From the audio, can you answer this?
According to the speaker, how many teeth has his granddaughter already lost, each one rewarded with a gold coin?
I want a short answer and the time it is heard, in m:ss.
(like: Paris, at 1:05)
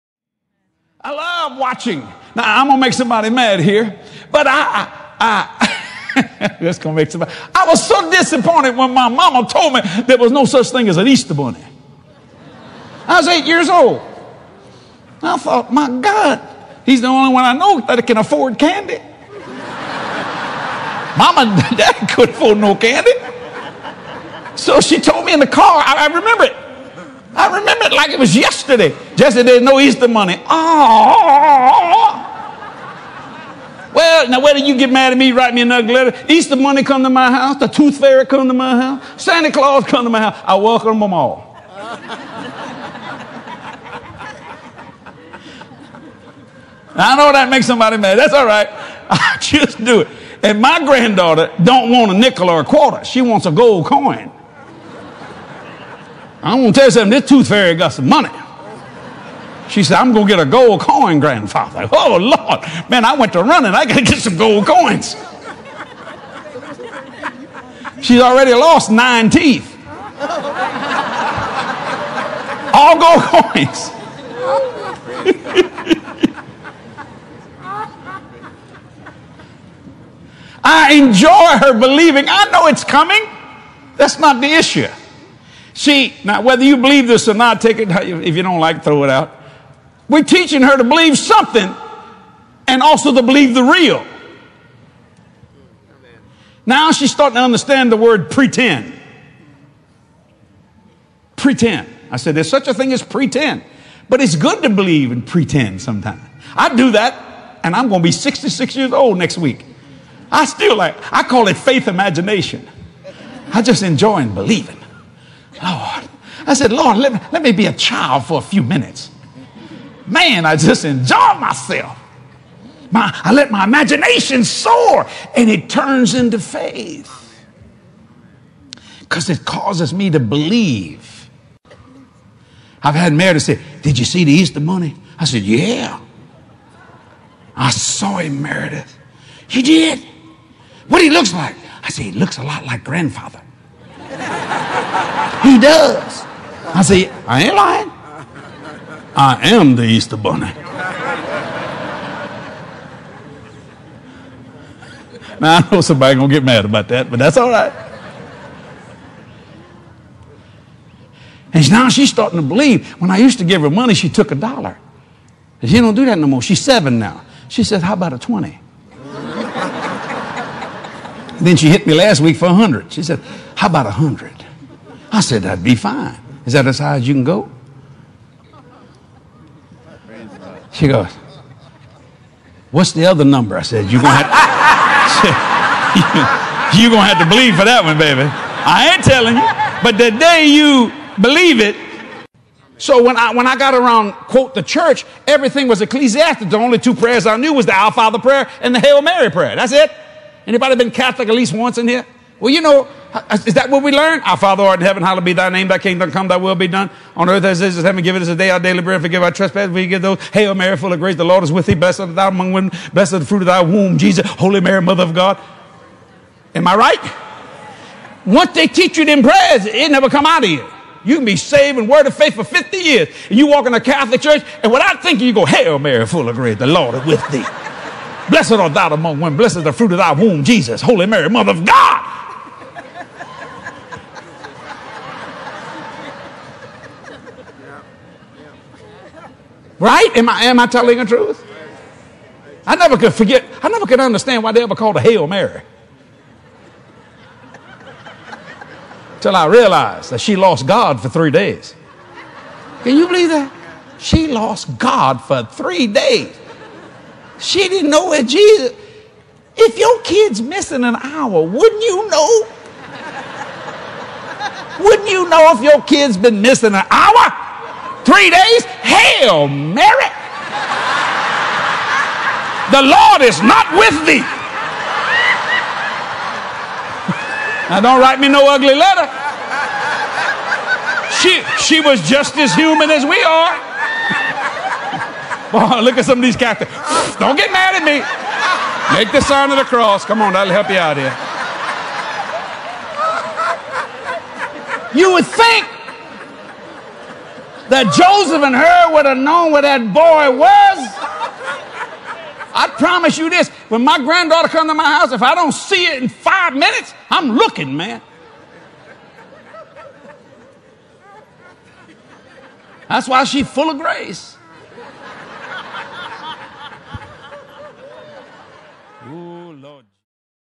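9, at 1:08.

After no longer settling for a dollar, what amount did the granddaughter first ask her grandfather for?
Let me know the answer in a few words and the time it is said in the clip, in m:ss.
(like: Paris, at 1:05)
20, at 2:48.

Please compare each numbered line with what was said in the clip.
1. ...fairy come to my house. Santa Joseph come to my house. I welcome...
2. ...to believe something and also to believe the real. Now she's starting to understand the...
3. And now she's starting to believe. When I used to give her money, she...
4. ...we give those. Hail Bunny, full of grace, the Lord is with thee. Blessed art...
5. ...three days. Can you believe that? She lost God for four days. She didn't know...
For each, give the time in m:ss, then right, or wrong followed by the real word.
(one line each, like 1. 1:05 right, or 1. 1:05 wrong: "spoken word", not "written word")
1. 0:37 wrong: "Claus", not "Joseph"
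2. 1:30 right
3. 2:41 right
4. 3:29 wrong: "Mary", not "Bunny"
5. 4:11 wrong: "three", not "four".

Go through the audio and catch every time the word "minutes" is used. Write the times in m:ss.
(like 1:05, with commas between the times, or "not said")
1:58, 5:06.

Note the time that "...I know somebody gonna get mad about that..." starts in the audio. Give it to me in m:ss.
2:35.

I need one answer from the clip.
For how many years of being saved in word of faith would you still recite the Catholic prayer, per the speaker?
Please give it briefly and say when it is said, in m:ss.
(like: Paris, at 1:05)
50 years, at 3:42.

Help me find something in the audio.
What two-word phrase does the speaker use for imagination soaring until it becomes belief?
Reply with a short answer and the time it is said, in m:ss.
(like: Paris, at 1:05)
faith imagination, at 1:51.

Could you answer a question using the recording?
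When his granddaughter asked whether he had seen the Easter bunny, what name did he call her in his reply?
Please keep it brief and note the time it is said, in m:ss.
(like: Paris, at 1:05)
Meredith, at 2:18.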